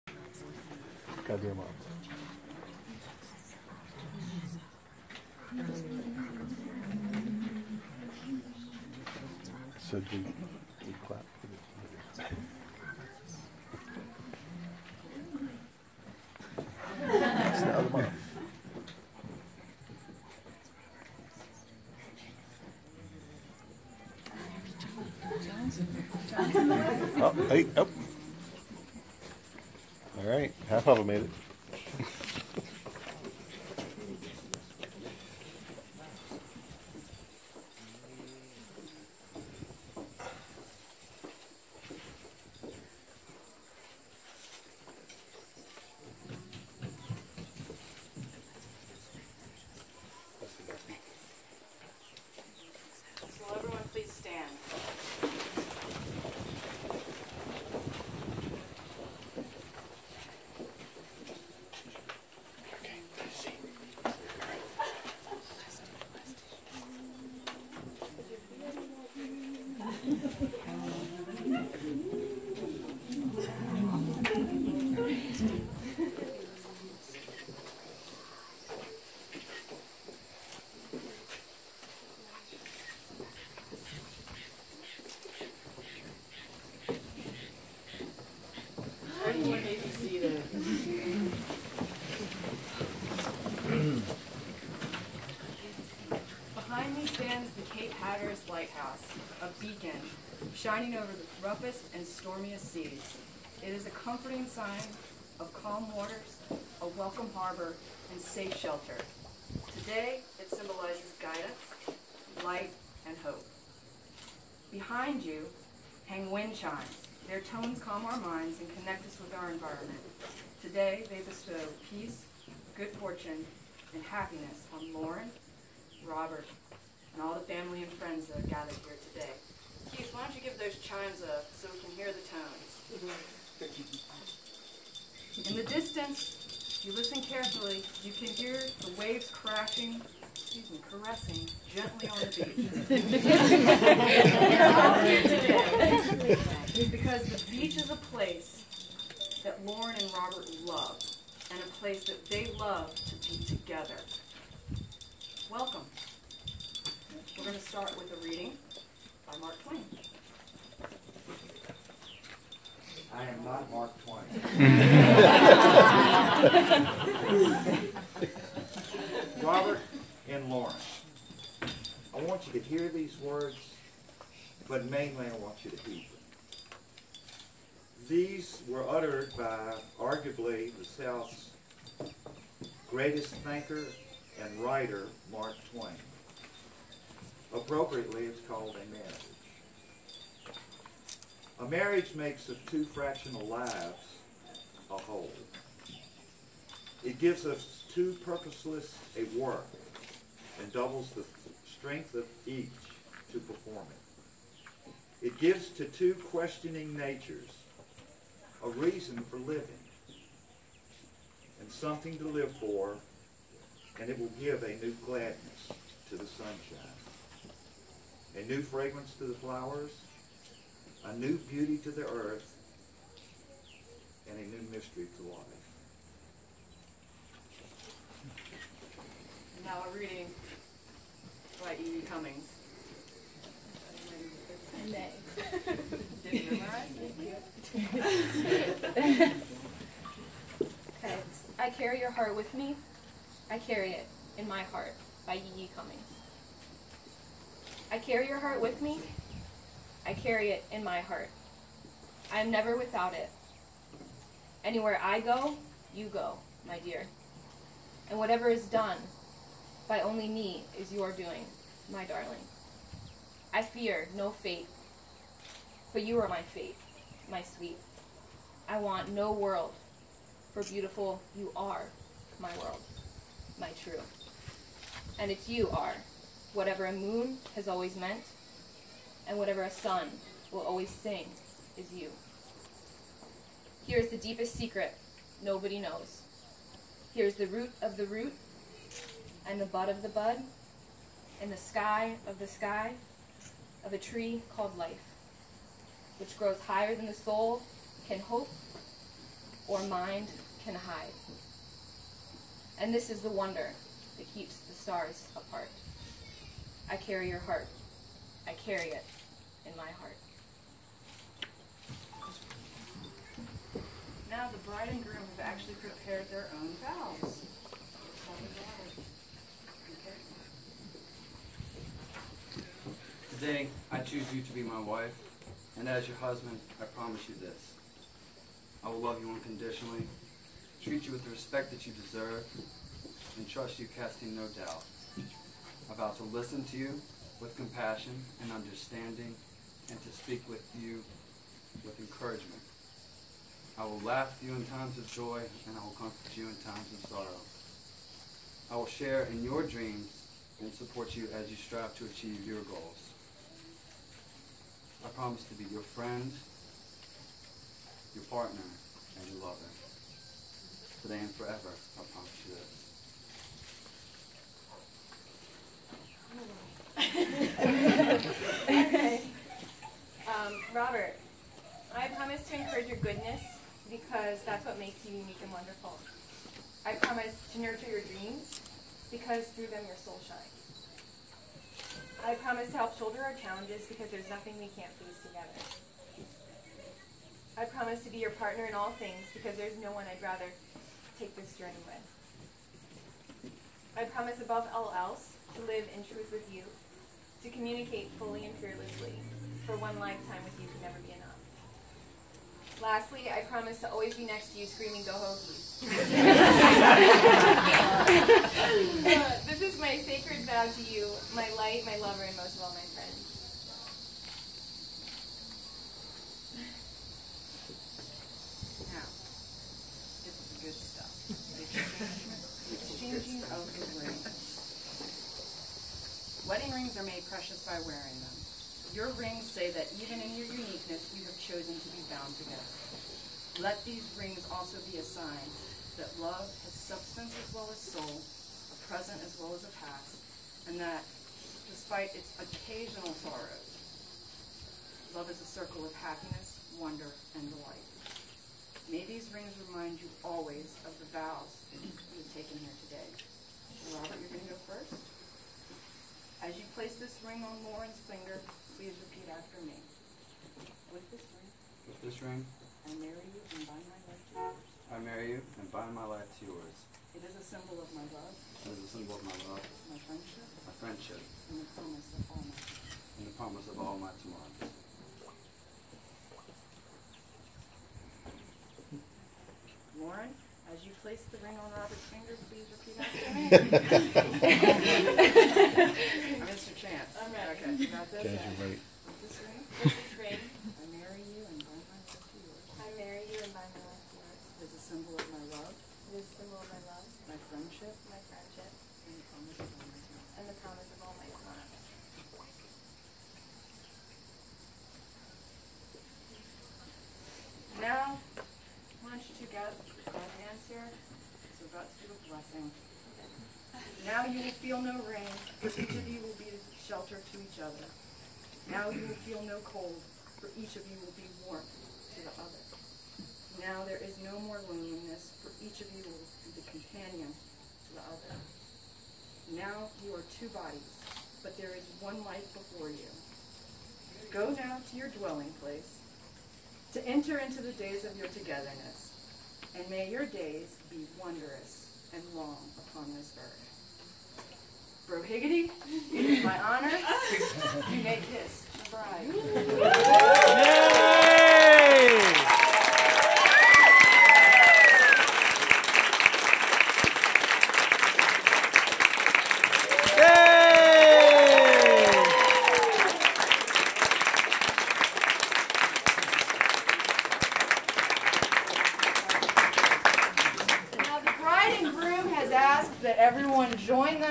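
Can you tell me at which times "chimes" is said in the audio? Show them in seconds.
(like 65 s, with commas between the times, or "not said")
116 s, 130 s.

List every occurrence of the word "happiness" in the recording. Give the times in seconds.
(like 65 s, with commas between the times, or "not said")
124 s, 446 s.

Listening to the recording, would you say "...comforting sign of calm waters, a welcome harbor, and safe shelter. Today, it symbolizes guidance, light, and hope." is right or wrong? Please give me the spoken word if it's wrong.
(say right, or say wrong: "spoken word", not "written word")
right.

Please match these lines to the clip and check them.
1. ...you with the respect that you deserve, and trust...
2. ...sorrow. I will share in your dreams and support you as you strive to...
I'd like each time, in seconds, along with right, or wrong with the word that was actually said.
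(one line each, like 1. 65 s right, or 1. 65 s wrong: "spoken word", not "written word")
1. 331 s right
2. 347 s right.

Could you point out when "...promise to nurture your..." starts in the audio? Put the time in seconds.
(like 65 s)
376 s.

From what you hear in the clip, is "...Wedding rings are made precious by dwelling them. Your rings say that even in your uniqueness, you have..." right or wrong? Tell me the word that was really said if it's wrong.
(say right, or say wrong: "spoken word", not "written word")
wrong: "wearing", not "dwelling".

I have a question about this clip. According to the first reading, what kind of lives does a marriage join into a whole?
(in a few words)
fractional.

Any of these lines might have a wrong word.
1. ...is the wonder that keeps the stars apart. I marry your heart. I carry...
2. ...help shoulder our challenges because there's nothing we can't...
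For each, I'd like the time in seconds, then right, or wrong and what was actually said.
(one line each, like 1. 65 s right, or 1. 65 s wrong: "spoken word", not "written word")
1. 303 s wrong: "carry", not "marry"
2. 382 s right.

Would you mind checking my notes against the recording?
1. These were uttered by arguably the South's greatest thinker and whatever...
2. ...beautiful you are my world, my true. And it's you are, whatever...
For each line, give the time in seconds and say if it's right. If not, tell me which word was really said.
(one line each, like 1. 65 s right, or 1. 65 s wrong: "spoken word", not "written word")
1. 178 s wrong: "writer", not "whatever"
2. 270 s right.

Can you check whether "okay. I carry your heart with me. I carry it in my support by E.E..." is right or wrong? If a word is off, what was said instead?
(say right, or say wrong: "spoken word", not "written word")
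wrong: "heart", not "support".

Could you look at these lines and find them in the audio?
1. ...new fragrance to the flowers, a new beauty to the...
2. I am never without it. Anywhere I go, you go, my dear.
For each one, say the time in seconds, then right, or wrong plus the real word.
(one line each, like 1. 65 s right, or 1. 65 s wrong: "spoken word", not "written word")
1. 218 s right
2. 252 s right.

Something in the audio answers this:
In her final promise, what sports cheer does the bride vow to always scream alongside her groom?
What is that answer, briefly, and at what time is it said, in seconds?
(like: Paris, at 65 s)
Go Hokies, at 405 s.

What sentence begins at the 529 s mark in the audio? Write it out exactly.
Now you are two bodies, but there is one life before you.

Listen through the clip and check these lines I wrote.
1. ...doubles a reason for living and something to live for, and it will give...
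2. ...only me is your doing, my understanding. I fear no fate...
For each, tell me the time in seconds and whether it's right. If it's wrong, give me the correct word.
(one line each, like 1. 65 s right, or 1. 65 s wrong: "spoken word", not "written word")
1. 206 s wrong: "natures", not "doubles"
2. 260 s wrong: "darling", not "understanding".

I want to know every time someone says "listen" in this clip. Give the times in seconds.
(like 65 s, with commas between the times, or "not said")
136 s, 336 s.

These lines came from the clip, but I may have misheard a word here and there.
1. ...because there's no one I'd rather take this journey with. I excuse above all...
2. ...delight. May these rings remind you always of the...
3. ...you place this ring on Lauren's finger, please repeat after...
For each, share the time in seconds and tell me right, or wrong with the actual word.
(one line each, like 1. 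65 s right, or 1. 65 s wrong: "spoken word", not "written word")
1. 389 s wrong: "promise", not "excuse"
2. 447 s right
3. 456 s right.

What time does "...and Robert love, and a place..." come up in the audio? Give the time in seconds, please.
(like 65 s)
149 s.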